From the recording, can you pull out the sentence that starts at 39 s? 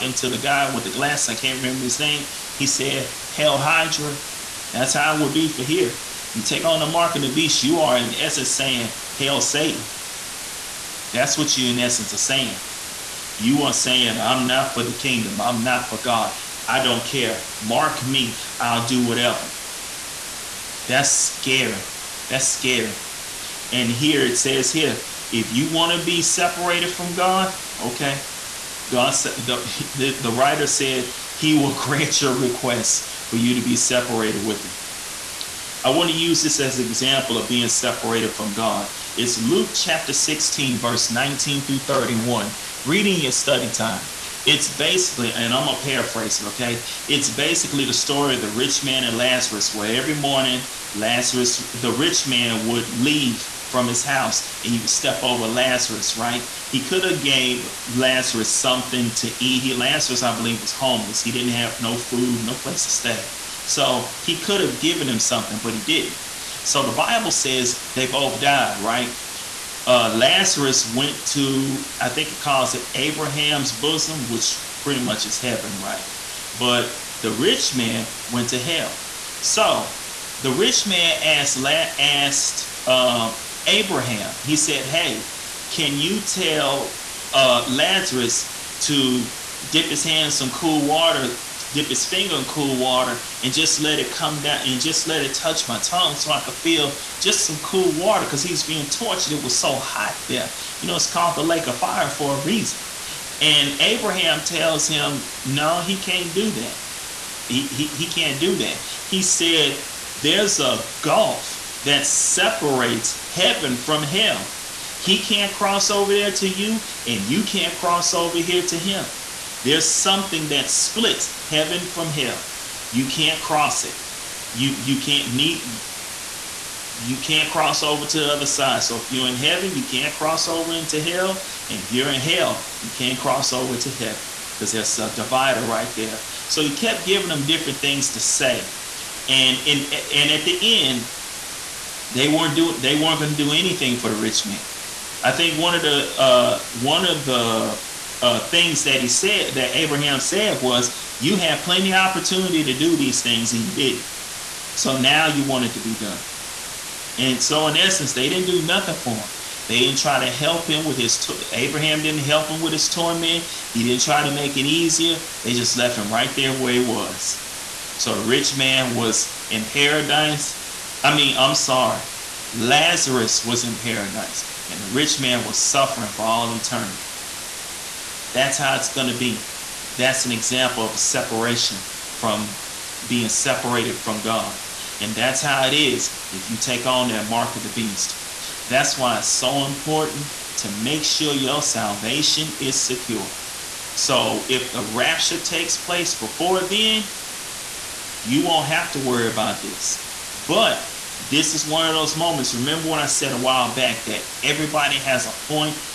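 It's Luke chapter 16, verse 19 through 31, reading your study time.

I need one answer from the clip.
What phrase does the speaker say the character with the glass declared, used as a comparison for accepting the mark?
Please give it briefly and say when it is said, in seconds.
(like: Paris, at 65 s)
Hail Hydra, at 3 s.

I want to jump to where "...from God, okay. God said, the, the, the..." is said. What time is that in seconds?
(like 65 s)
26 s.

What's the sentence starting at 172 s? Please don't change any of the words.
Lazarus was in paradise and the rich man was suffering for all eternity.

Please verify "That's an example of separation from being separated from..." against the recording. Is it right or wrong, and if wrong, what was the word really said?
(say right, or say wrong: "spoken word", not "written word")
right.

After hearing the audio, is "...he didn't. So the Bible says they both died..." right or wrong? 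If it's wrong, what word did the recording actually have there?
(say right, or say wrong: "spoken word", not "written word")
right.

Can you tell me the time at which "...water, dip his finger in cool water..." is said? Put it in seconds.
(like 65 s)
90 s.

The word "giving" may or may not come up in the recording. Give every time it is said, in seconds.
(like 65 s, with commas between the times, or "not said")
137 s.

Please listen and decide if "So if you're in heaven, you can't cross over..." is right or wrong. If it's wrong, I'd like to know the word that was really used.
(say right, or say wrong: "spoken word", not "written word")
right.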